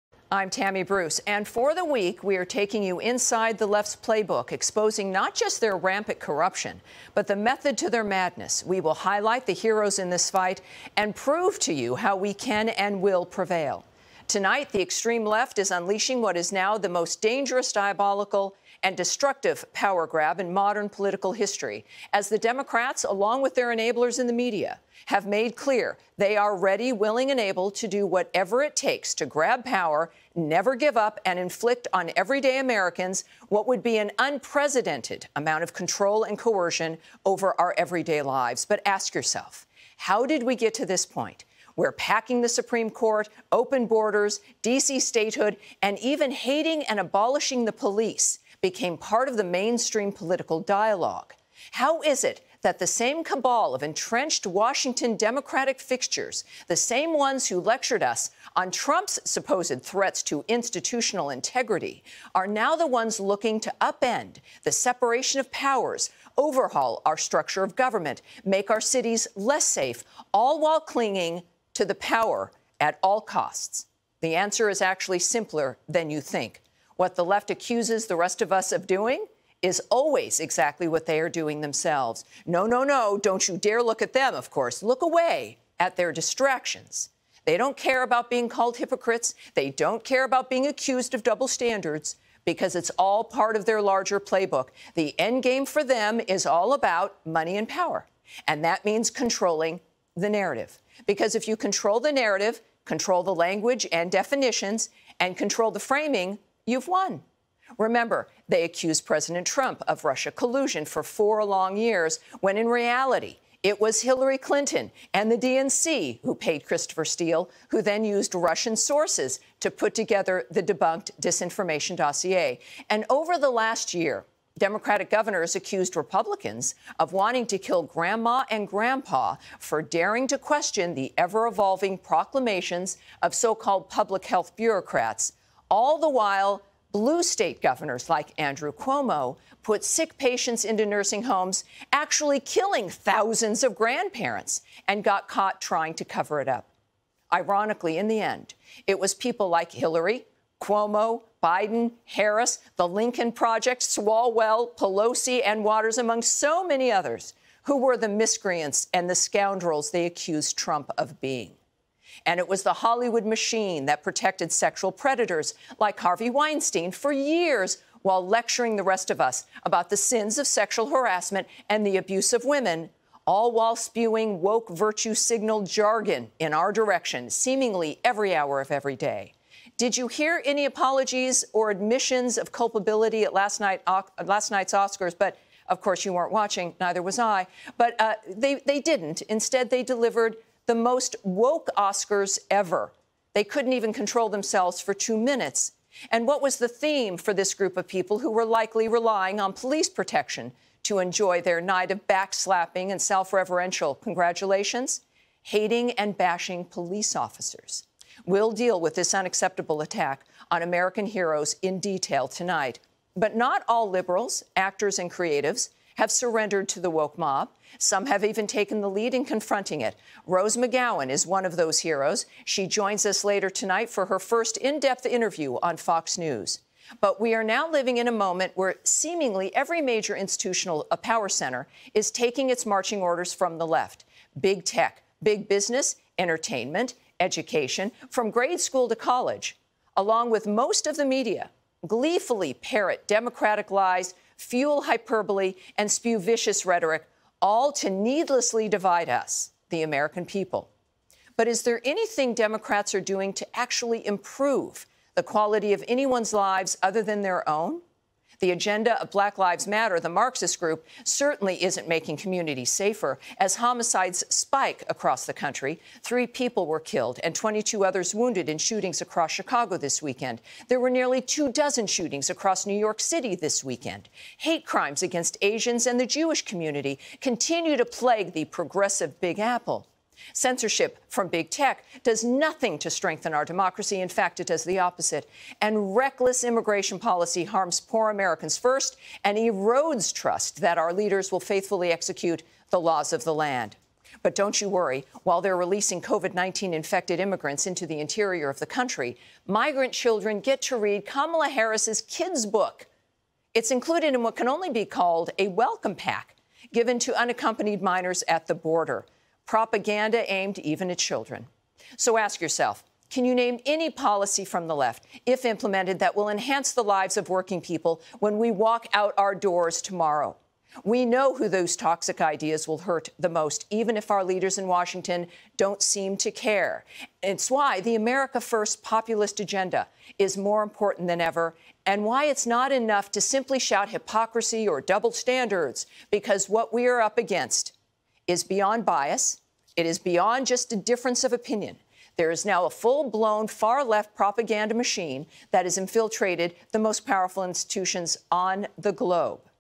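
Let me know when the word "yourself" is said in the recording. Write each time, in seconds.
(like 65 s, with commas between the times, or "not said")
39 s, 312 s.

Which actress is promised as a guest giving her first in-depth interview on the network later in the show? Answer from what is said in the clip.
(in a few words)
Rose McGowan.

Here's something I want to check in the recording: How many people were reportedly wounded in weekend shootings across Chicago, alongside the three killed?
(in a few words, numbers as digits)
22.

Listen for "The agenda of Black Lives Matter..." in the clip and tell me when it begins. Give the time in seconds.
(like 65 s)
258 s.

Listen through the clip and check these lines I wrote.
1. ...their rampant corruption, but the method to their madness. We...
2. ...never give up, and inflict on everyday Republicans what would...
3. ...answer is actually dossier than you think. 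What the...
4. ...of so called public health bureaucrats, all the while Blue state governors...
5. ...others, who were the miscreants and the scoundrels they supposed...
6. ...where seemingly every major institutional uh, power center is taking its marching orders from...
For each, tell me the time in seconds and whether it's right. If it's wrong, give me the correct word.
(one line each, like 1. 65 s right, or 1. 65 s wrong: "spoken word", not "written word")
1. 5 s right
2. 30 s wrong: "Americans", not "Republicans"
3. 74 s wrong: "simpler", not "dossier"
4. 133 s right
5. 156 s wrong: "accused", not "supposed"
6. 228 s right.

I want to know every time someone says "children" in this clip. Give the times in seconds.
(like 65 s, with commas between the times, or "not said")
299 s, 310 s.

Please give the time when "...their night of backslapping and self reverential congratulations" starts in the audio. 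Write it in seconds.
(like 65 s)
201 s.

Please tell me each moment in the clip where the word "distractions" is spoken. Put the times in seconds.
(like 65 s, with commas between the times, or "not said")
86 s.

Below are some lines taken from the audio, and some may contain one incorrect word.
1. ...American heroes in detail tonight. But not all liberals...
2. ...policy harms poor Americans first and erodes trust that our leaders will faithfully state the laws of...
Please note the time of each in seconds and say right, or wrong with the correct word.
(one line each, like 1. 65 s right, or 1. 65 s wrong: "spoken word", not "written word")
1. 210 s right
2. 286 s wrong: "execute", not "state".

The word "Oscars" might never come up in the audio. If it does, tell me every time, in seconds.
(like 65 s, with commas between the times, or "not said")
184 s, 191 s.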